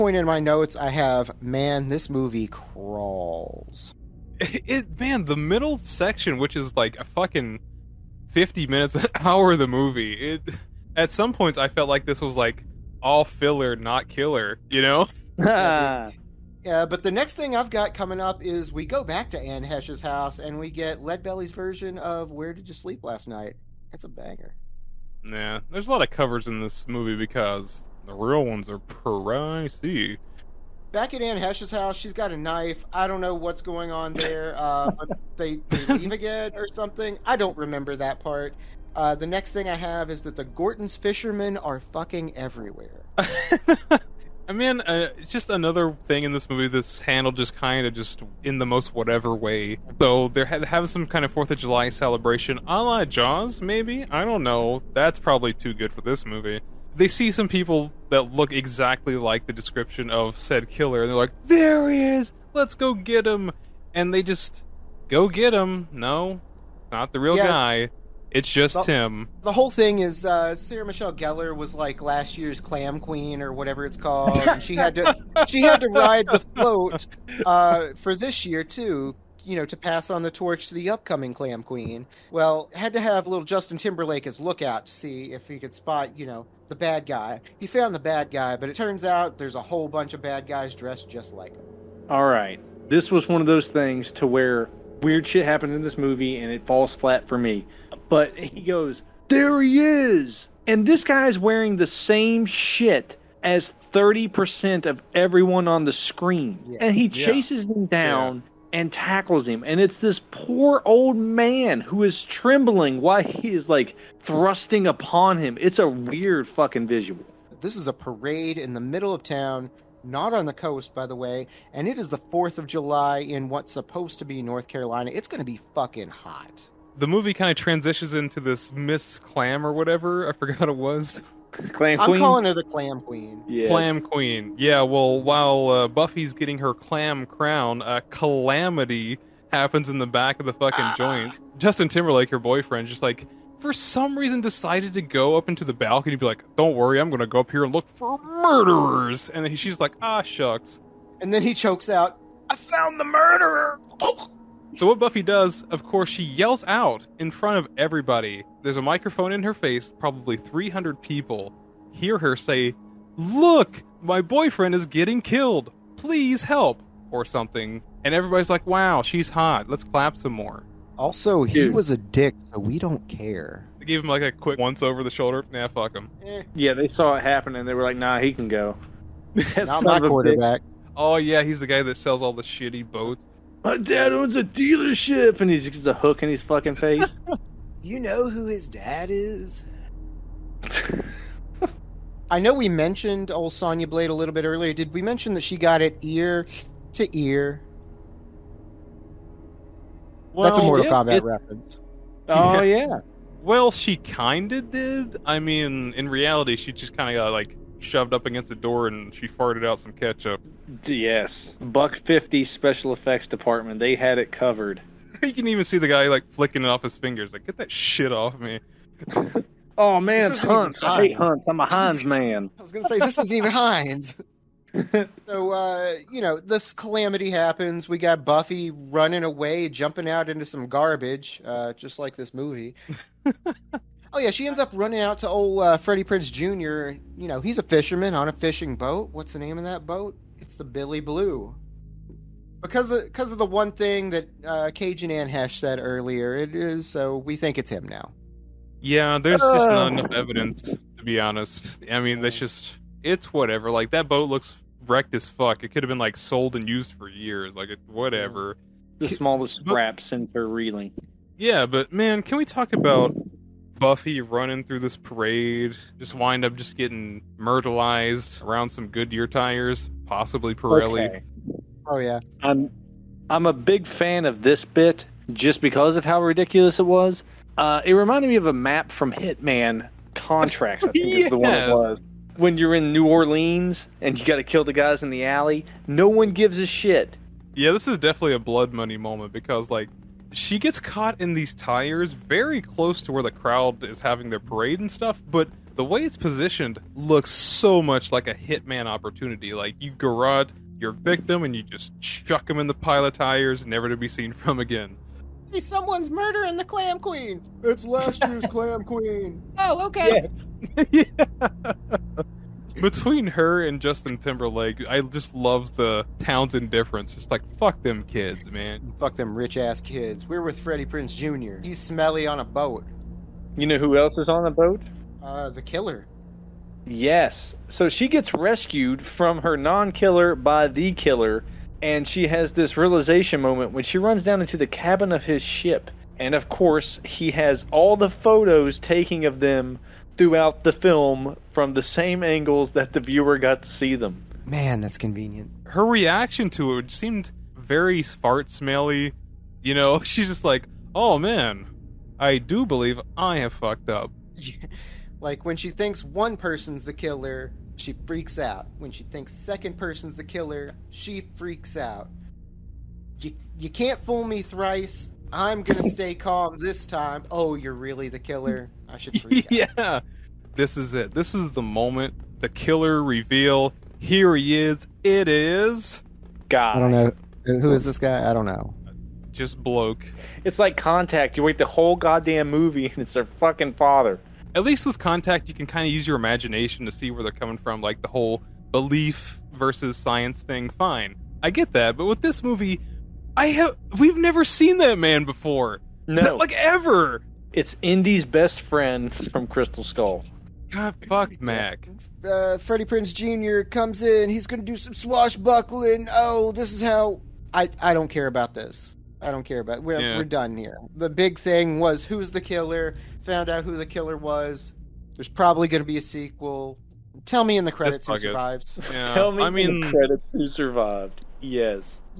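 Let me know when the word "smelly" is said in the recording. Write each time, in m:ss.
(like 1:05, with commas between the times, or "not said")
5:21, 5:48.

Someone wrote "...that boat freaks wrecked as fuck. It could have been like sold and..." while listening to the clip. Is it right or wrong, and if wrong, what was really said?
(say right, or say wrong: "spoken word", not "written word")
wrong: "looks", not "freaks".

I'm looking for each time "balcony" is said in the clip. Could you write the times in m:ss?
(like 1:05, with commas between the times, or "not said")
2:25.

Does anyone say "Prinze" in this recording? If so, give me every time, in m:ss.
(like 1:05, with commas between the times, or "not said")
3:56, 5:20, 6:42.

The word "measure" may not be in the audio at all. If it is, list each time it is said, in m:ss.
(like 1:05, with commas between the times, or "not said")
not said.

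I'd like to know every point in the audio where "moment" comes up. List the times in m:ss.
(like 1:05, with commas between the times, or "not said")
4:48, 5:33, 6:11.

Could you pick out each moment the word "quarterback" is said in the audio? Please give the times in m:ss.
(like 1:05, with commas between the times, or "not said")
3:00.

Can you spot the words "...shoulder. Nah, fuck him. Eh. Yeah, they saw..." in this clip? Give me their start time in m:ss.
2:55.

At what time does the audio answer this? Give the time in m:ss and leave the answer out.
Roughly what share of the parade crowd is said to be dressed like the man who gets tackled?
1:43.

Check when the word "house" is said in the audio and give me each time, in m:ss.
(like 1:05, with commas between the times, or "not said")
0:20, 0:31.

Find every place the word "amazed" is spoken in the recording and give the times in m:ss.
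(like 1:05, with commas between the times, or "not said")
not said.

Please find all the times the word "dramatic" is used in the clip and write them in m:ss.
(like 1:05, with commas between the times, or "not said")
not said.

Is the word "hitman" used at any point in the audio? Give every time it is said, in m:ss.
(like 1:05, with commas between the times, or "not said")
4:39, 4:58.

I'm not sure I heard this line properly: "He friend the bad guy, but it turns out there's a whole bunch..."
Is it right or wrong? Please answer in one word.
wrong.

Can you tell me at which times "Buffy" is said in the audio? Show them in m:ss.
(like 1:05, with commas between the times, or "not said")
2:15, 2:34, 3:48, 4:23.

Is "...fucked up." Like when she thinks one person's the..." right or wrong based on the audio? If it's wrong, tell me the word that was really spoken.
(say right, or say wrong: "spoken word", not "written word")
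right.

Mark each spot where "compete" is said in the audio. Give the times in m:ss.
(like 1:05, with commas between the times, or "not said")
not said.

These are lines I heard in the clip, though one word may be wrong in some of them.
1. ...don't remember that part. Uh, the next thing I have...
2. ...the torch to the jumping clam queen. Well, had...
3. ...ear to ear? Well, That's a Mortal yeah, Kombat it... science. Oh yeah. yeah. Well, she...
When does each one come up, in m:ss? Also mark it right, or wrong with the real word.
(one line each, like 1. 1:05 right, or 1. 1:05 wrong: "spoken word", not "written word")
1. 0:37 right
2. 1:20 wrong: "upcoming", not "jumping"
3. 3:16 wrong: "reference", not "science".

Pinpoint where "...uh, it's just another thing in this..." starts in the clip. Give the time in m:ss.
0:44.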